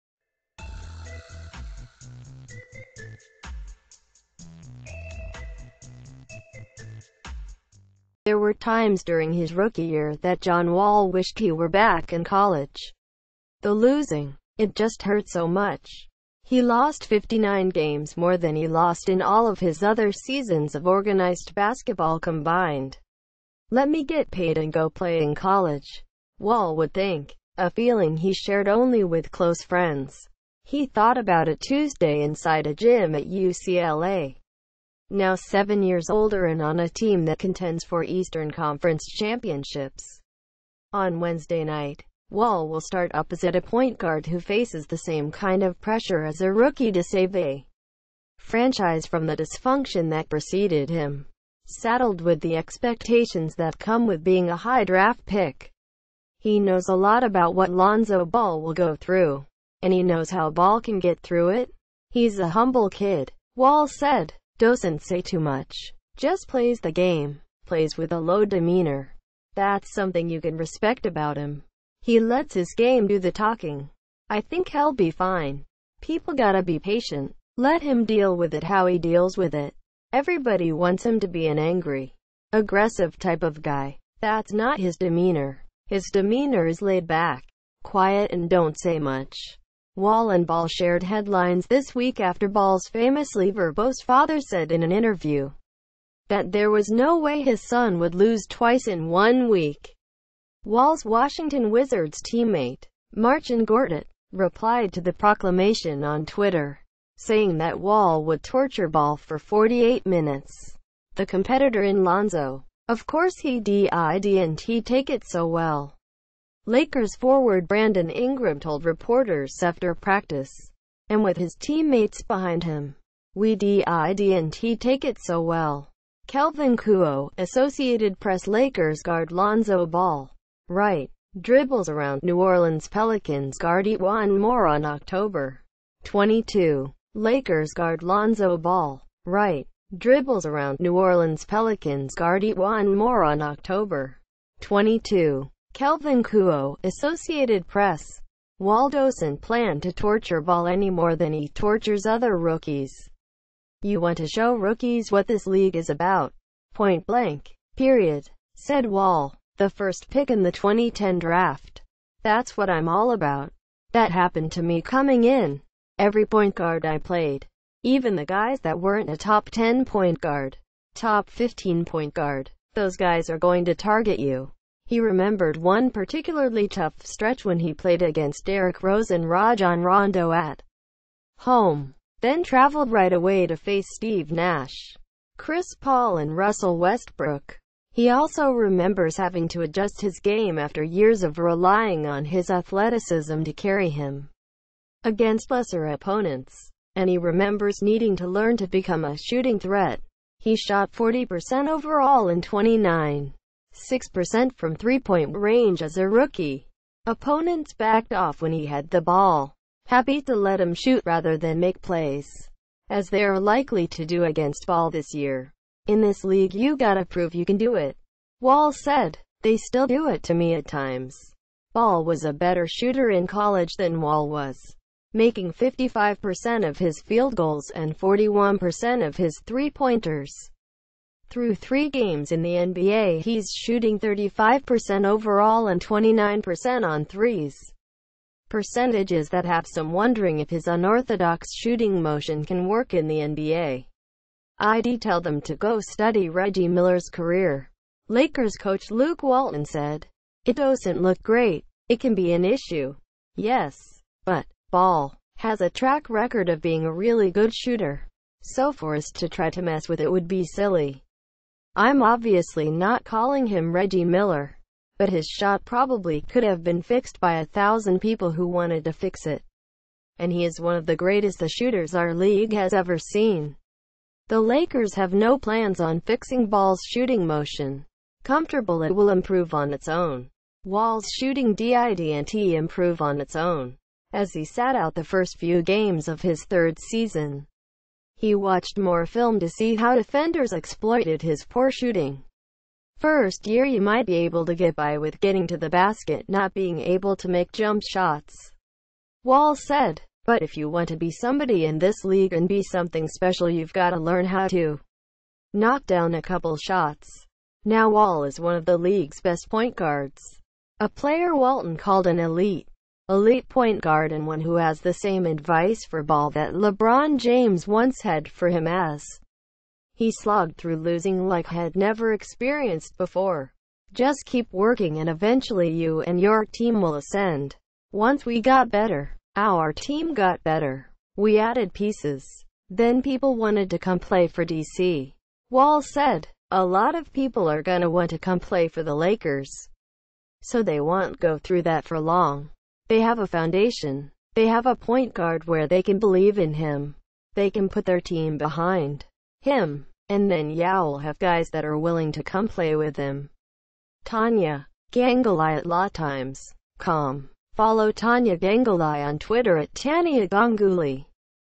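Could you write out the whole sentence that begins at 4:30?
And he is one of the greatest shooters our league has ever seen.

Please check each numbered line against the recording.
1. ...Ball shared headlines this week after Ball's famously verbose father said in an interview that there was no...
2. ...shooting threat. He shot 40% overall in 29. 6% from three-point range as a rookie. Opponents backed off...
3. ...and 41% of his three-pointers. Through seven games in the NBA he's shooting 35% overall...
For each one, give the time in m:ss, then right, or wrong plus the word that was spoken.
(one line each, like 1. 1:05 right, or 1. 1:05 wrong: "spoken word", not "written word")
1. 1:30 right
2. 3:19 right
3. 3:47 wrong: "three", not "seven".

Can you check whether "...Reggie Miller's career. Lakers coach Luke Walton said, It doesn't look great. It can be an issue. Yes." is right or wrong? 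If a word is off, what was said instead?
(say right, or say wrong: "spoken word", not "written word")
right.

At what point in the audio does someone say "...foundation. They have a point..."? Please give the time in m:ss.
5:43.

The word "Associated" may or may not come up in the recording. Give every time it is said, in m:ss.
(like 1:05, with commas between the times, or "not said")
2:07, 2:26.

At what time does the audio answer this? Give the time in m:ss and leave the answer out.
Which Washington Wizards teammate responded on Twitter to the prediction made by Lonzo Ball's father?
1:43.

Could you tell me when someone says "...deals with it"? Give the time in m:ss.
1:18.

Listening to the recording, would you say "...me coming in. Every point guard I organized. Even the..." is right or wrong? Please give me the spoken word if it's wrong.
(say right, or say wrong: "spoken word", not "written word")
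wrong: "played", not "organized".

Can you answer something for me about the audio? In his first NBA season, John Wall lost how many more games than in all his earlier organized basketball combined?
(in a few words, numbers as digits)
59.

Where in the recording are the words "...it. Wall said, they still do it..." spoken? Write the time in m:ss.
3:37.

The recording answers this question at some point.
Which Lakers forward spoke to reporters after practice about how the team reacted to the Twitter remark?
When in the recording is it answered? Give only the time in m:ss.
1:57.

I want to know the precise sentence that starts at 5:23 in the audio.
Just keep working and eventually you and your team will ascend.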